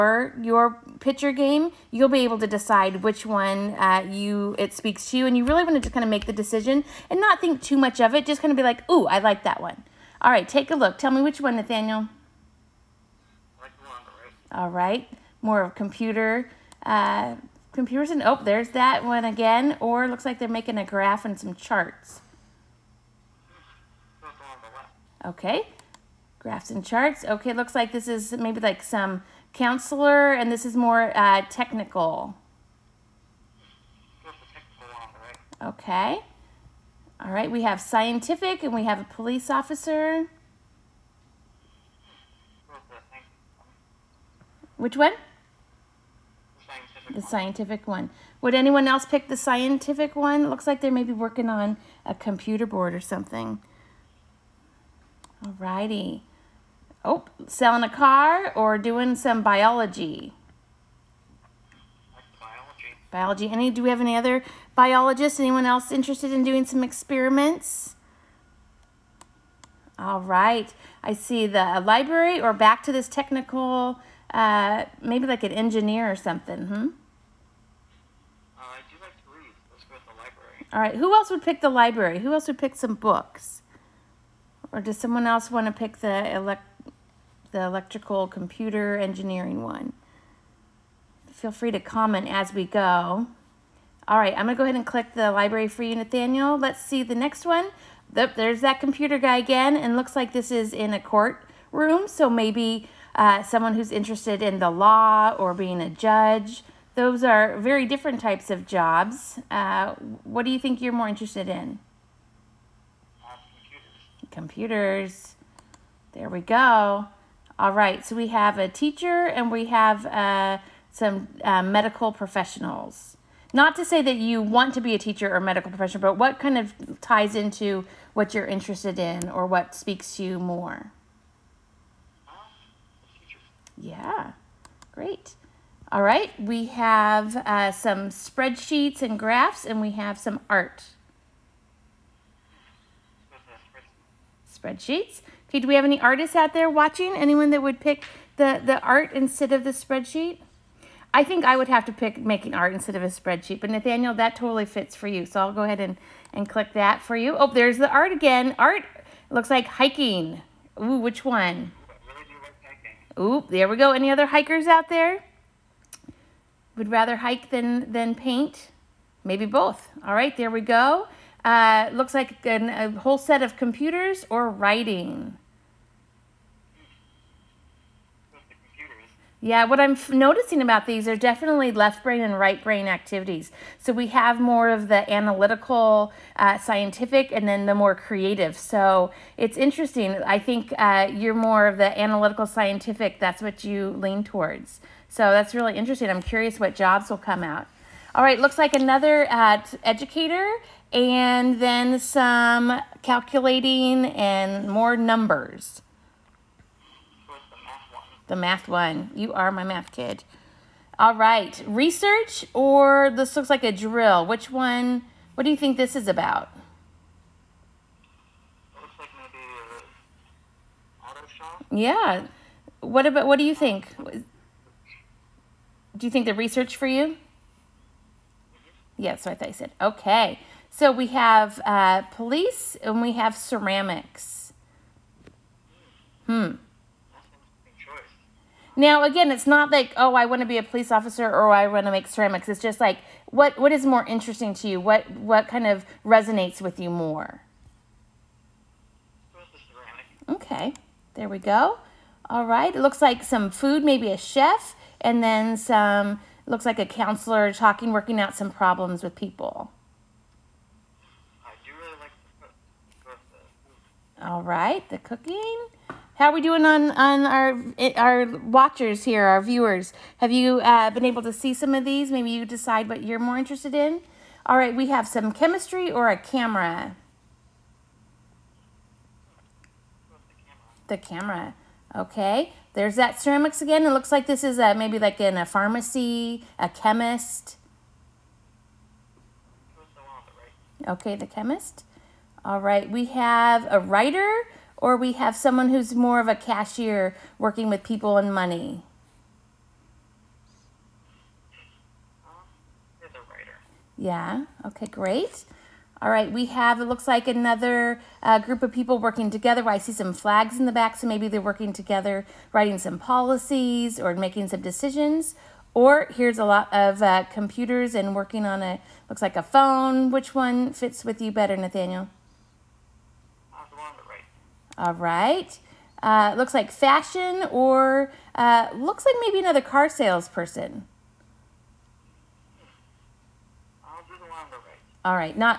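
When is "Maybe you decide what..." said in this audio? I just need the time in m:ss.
4:32.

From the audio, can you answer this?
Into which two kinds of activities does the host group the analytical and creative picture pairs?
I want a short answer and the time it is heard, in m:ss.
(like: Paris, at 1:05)
Left brain and right brain, at 3:01.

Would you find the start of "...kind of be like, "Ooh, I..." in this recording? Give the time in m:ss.
0:08.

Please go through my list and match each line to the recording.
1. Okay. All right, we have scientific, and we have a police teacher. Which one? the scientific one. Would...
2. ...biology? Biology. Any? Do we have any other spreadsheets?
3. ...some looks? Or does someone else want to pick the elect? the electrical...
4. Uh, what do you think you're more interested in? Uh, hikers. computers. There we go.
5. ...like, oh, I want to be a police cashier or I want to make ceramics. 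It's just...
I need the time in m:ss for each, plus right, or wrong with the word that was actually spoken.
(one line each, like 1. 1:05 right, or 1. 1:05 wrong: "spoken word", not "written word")
1. 0:35 wrong: "officer", not "teacher"
2. 0:59 wrong: "biologists", not "spreadsheets"
3. 1:22 wrong: "books", not "looks"
4. 1:49 wrong: "computers", not "hikers"
5. 3:59 wrong: "officer", not "cashier".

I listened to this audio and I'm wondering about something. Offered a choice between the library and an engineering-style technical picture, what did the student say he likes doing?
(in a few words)
Read.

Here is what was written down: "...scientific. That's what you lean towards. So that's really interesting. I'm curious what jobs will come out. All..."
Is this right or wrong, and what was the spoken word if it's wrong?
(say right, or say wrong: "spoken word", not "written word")
right.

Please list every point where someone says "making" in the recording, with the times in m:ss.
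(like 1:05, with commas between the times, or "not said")
0:20, 2:32, 5:14.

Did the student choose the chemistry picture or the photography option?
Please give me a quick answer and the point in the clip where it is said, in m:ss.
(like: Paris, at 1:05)
The camera, at 4:40.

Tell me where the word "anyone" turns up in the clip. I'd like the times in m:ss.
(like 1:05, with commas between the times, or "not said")
0:48, 1:05, 2:27.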